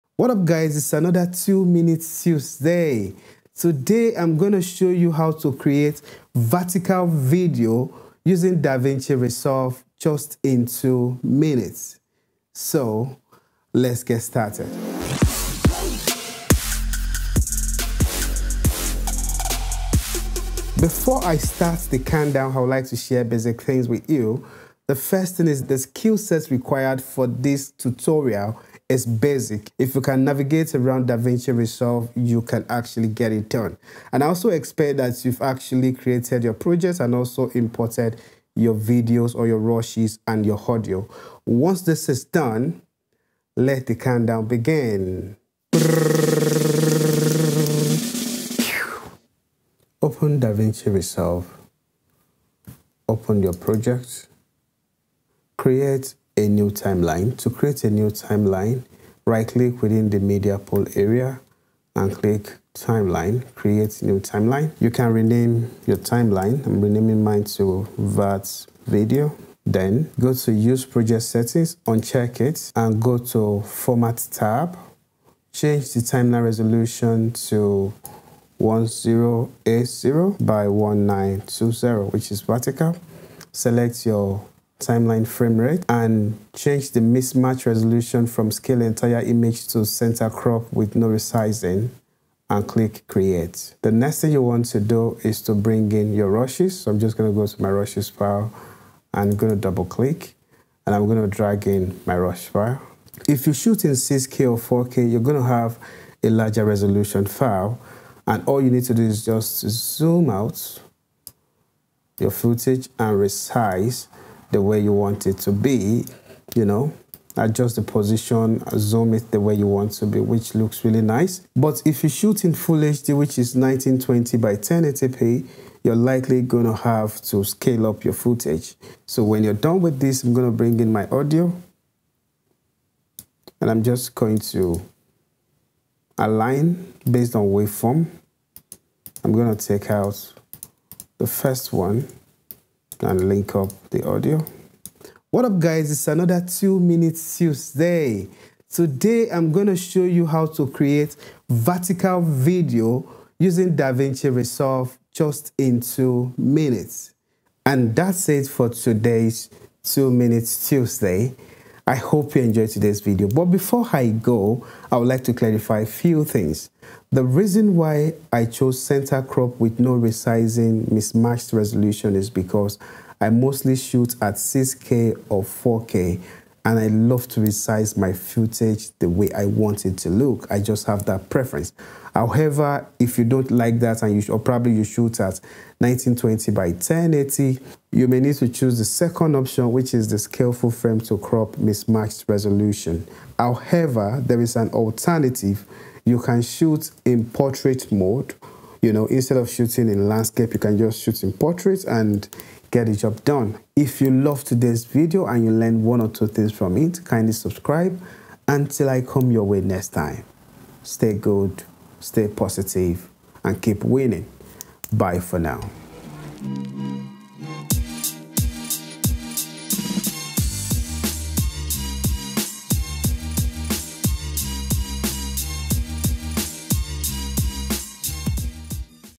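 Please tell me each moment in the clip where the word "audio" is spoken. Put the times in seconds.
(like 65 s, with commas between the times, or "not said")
40 s, 131 s, 144 s.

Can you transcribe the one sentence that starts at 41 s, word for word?
Once this is done, let the countdown begin.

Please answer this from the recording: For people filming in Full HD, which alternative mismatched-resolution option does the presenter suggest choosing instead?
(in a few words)
Full frame to crop.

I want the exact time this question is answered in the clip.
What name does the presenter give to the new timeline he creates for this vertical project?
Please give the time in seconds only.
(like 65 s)
67 s.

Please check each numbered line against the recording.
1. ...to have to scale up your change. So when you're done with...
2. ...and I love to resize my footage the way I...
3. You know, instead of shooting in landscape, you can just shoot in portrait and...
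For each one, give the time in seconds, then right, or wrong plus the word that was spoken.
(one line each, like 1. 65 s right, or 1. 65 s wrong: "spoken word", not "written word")
1. 126 s wrong: "footage", not "change"
2. 176 s right
3. 198 s right.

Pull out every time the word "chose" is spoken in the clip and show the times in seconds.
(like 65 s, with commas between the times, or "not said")
168 s.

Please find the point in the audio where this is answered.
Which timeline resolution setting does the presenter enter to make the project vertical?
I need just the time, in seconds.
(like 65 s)
78 s.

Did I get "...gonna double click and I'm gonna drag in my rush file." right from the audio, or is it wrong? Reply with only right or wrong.
right.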